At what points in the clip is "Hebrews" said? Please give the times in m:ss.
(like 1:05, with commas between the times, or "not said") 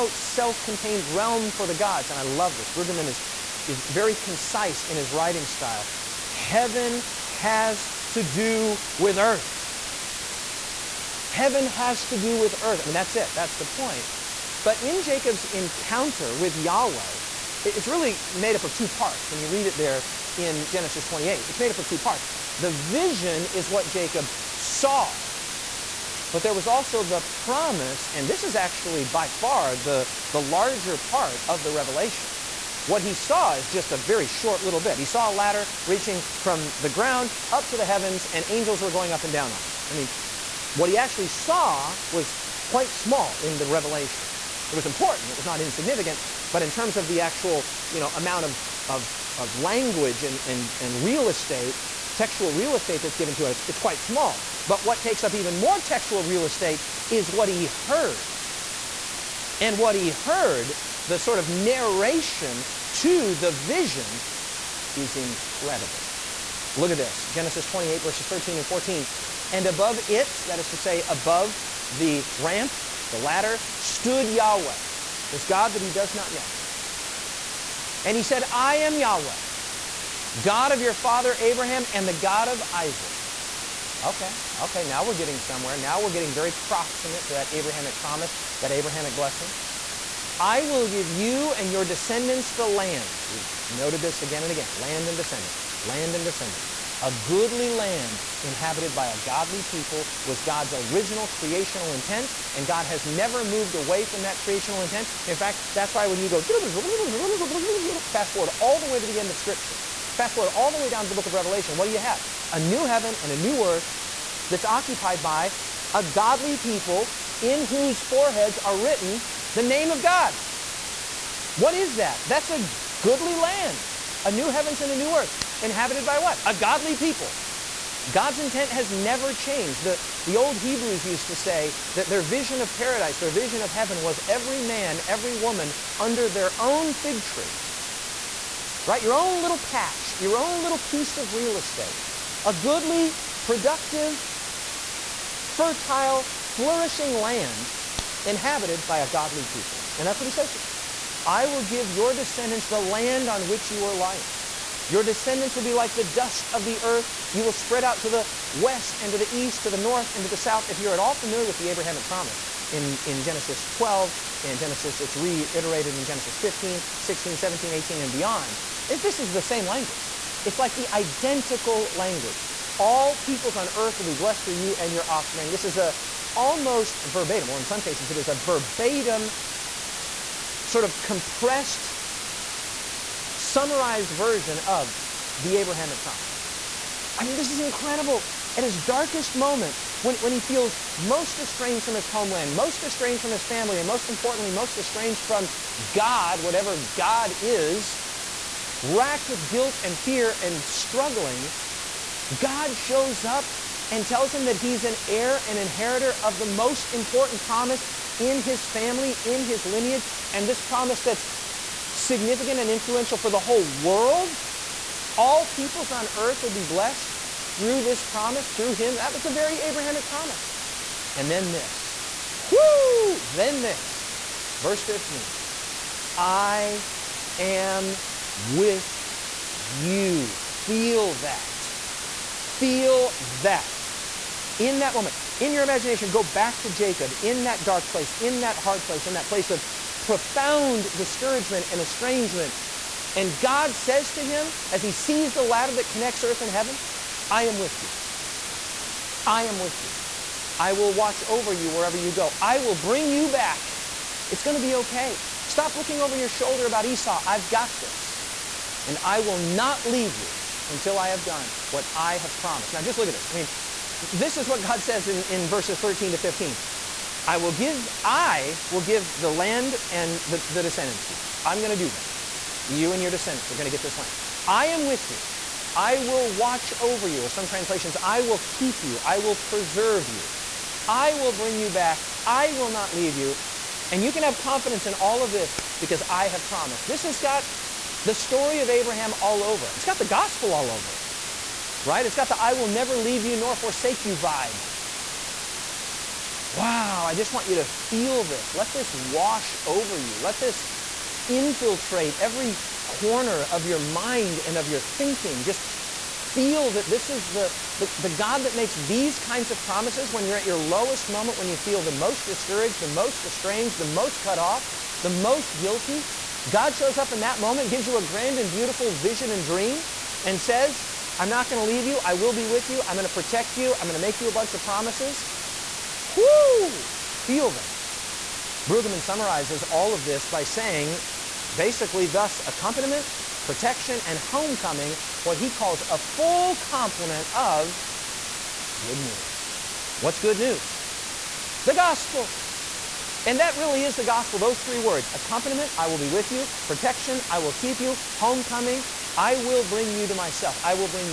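2:10.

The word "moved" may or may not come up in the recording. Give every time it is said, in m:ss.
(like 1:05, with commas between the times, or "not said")
1:43.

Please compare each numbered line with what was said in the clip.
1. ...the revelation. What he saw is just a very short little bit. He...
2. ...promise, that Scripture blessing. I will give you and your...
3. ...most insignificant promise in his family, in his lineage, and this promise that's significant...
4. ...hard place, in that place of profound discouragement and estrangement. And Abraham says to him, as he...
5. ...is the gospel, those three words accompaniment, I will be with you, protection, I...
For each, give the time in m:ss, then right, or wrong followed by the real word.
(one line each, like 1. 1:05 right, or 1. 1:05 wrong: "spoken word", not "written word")
1. 0:31 right
2. 1:27 wrong: "Abrahamic", not "Scripture"
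3. 3:26 wrong: "important", not "insignificant"
4. 3:58 wrong: "God", not "Abraham"
5. 5:43 right.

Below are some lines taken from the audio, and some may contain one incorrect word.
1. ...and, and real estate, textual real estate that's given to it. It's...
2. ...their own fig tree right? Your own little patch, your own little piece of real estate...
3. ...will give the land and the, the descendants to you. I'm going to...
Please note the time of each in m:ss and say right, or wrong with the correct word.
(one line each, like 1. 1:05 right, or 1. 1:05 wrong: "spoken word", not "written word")
1. 0:50 right
2. 2:16 right
3. 4:28 right.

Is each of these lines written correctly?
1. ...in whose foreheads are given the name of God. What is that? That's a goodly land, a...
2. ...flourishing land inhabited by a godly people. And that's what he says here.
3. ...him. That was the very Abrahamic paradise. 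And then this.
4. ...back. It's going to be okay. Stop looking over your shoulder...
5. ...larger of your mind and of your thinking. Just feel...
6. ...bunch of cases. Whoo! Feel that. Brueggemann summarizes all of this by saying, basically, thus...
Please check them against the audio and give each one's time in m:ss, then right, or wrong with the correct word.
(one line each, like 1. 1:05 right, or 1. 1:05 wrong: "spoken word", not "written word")
1. 1:57 wrong: "written", not "given"
2. 2:26 right
3. 3:38 wrong: "promise", not "paradise"
4. 4:13 right
5. 5:02 wrong: "corner", not "larger"
6. 5:24 wrong: "promises", not "cases".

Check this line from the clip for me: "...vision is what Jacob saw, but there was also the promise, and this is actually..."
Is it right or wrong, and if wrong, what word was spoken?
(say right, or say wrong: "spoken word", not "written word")
right.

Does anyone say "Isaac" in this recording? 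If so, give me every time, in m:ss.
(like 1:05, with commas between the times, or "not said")
1:22.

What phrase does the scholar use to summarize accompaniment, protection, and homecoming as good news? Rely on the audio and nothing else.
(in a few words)
A full complement of good news.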